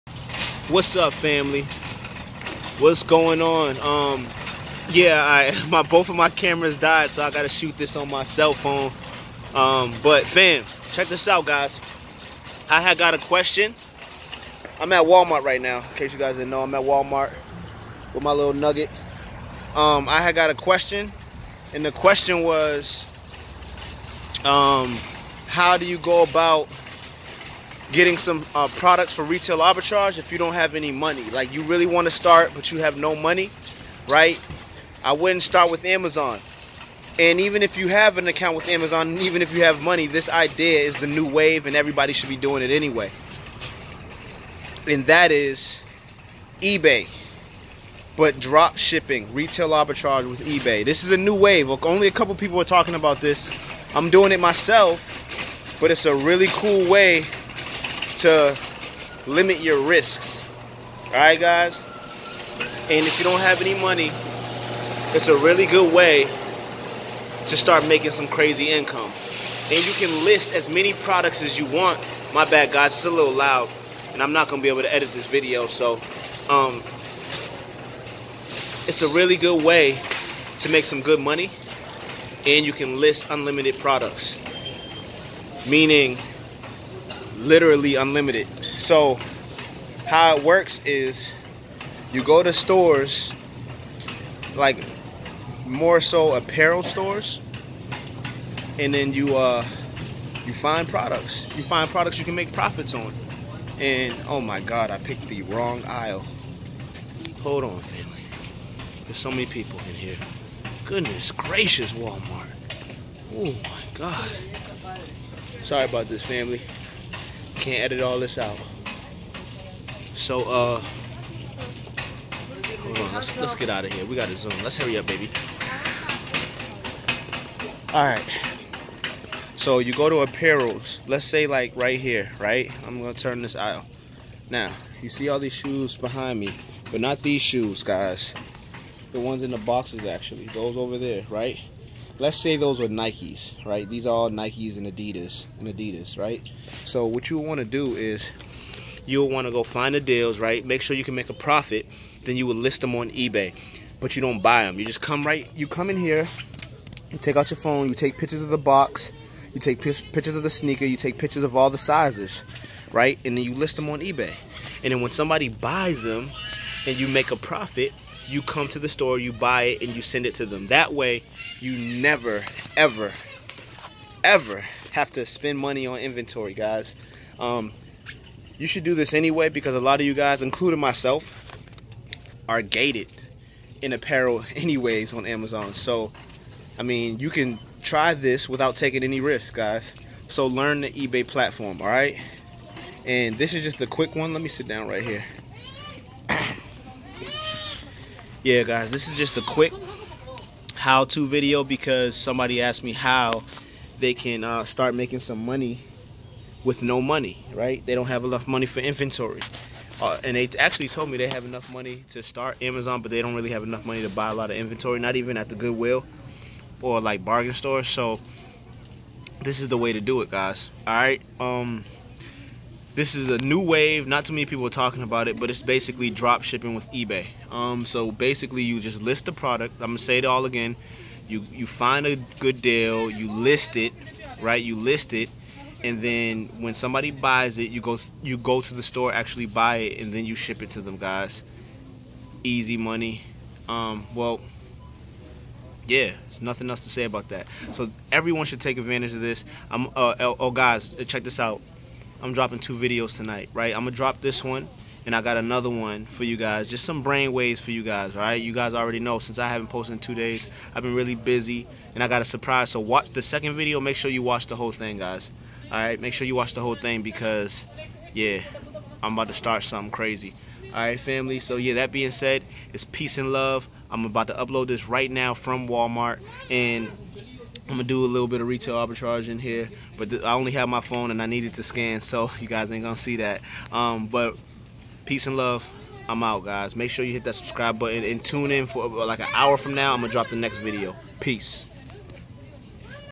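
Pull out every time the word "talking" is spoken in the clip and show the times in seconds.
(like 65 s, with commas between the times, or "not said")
52 s, 224 s.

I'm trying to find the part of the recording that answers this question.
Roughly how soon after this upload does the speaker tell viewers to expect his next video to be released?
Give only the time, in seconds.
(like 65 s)
289 s.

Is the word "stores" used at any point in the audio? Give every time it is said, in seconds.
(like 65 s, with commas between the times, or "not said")
92 s, 96 s, 168 s, 217 s, 238 s.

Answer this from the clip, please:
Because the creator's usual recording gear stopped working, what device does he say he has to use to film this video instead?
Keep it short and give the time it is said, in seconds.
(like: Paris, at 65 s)
cell phone, at 8 s.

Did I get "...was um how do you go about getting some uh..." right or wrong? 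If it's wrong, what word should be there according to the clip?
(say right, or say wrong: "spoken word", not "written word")
right.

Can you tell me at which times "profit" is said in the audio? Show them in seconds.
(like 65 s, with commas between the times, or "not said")
102 s, 151 s, 167 s.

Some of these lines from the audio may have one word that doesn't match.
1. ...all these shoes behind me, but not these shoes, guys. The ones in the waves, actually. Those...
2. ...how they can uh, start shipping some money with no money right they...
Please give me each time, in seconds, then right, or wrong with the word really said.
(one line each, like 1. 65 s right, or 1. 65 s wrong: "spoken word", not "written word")
1. 135 s wrong: "boxes", not "waves"
2. 202 s wrong: "making", not "shipping".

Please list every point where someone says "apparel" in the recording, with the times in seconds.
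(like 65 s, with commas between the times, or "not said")
96 s, 130 s, 183 s.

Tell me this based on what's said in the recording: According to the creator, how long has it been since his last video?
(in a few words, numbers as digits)
2 days.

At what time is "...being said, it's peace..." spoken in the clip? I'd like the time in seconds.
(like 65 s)
271 s.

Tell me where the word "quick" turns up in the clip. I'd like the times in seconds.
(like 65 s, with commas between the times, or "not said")
193 s, 199 s.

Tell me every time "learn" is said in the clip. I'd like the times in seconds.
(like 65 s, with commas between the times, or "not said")
190 s.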